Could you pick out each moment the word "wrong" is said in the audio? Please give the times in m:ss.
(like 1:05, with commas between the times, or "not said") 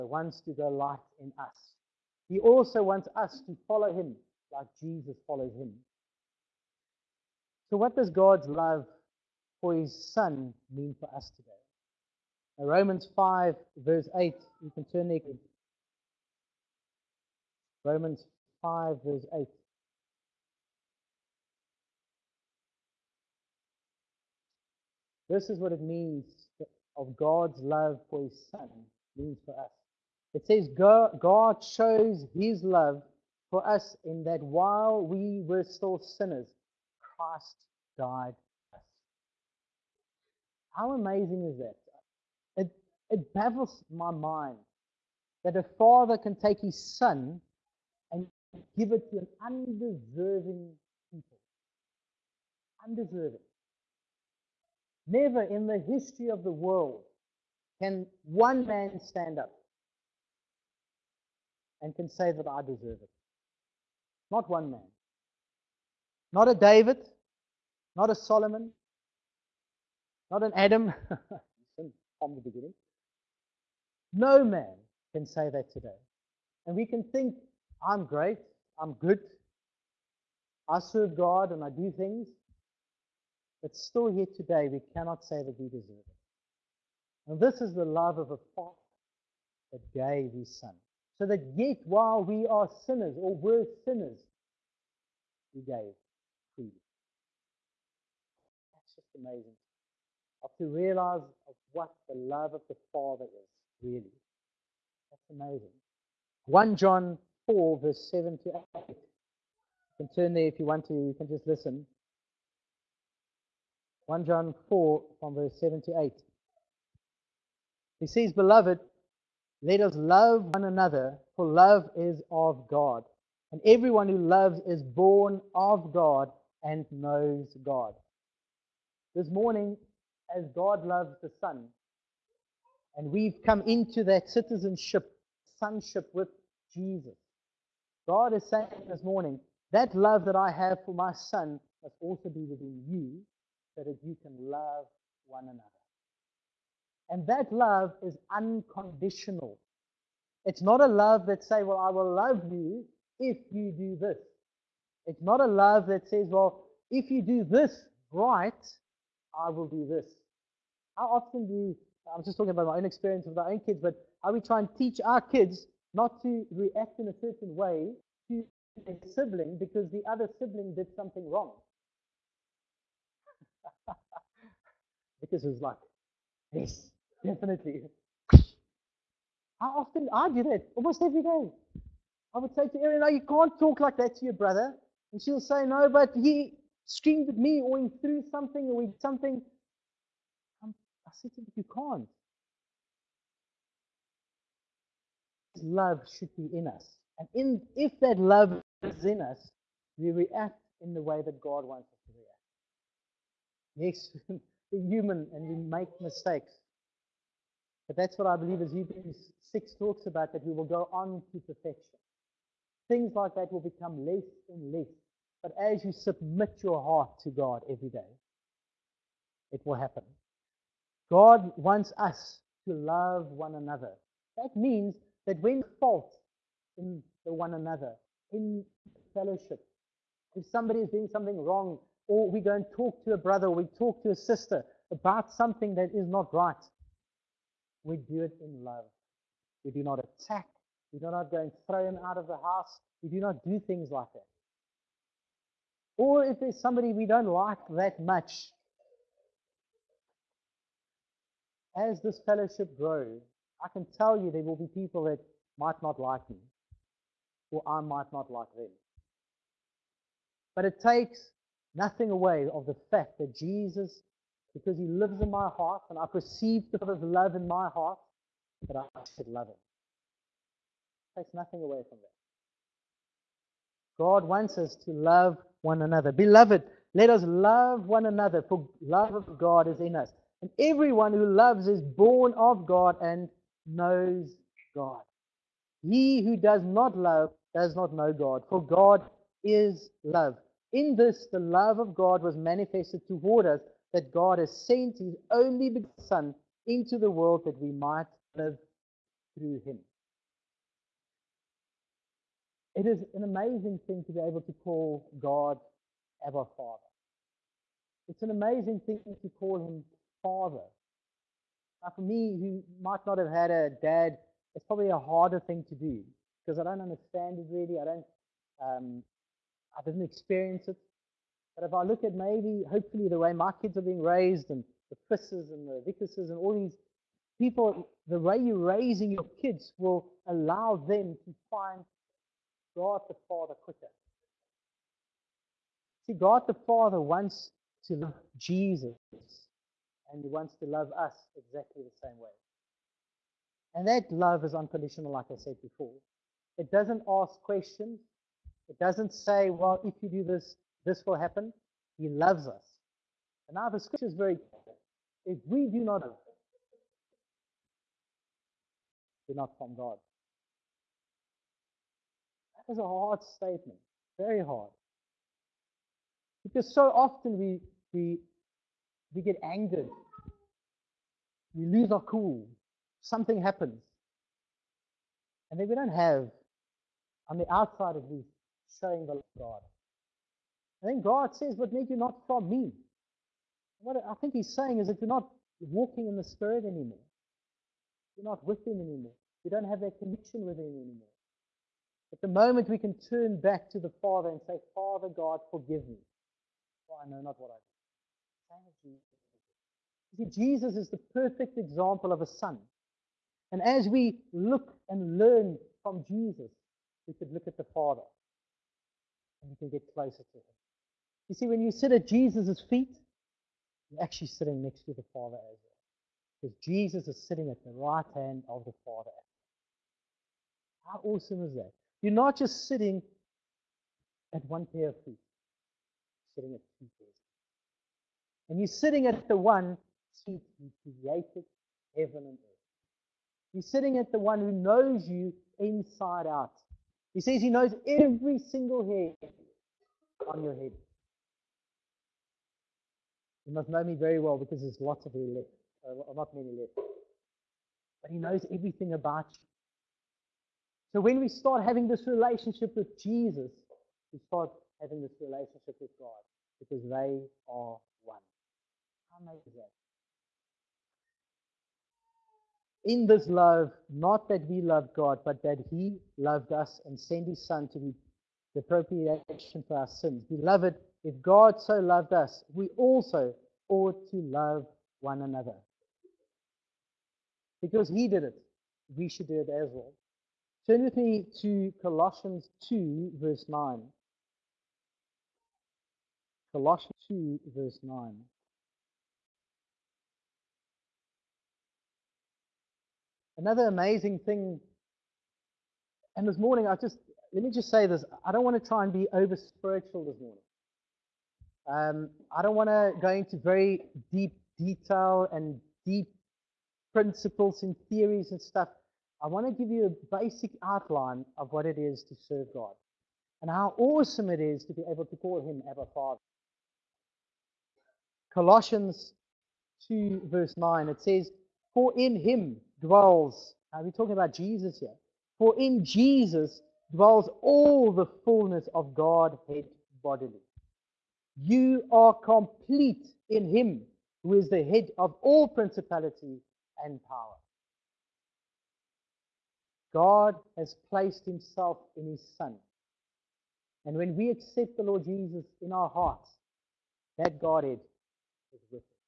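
2:51, 3:51.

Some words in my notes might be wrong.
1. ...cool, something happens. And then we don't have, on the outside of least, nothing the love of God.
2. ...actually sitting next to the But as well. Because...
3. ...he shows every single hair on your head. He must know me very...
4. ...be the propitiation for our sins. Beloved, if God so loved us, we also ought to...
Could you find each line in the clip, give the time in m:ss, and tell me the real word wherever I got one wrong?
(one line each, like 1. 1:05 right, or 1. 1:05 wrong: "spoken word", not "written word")
1. 6:12 wrong: "showing", not "nothing"
2. 6:54 wrong: "Father", not "But"
3. 7:17 wrong: "knows", not "shows"
4. 7:47 right.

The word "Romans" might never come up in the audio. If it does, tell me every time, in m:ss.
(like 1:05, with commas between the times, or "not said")
0:12, 0:17.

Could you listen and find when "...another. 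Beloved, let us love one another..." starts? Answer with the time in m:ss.
4:35.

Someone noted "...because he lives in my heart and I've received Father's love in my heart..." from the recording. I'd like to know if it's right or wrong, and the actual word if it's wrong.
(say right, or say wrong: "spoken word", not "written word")
right.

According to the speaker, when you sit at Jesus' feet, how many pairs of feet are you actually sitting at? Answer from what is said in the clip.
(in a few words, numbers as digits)
2.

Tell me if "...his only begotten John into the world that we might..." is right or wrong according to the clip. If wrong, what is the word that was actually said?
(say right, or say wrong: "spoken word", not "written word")
wrong: "Son", not "John".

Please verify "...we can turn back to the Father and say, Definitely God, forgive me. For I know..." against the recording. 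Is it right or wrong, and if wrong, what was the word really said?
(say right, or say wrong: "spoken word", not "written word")
wrong: "Father", not "Definitely".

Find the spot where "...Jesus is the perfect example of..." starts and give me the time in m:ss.
6:40.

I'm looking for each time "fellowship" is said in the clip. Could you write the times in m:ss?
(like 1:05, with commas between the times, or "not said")
3:49, 4:12.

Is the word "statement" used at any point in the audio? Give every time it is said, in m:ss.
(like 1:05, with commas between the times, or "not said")
6:03.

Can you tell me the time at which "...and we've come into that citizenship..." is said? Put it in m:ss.
2:12.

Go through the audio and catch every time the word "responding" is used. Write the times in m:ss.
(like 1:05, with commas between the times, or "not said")
not said.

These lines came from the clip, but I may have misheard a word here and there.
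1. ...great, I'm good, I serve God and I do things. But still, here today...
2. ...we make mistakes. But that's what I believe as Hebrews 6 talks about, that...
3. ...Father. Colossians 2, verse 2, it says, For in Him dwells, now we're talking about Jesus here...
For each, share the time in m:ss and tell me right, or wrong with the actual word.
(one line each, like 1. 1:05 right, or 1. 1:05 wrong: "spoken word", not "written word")
1. 1:18 right
2. 3:25 right
3. 8:35 wrong: "9", not "2".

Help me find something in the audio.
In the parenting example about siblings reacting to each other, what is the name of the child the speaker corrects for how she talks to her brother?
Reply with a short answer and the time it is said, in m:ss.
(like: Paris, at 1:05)
Erin, at 3:02.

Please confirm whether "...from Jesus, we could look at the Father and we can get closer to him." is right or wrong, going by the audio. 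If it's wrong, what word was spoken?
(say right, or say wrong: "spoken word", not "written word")
right.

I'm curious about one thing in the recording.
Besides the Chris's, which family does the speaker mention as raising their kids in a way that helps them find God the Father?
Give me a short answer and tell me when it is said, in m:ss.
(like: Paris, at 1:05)
The Vickerses, at 5:25.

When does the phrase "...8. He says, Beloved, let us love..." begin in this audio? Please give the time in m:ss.
1:56.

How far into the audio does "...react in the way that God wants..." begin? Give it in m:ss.
3:20.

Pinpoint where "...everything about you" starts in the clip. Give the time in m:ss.
7:28.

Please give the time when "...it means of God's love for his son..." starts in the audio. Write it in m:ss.
0:25.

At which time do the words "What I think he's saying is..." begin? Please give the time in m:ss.
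6:23.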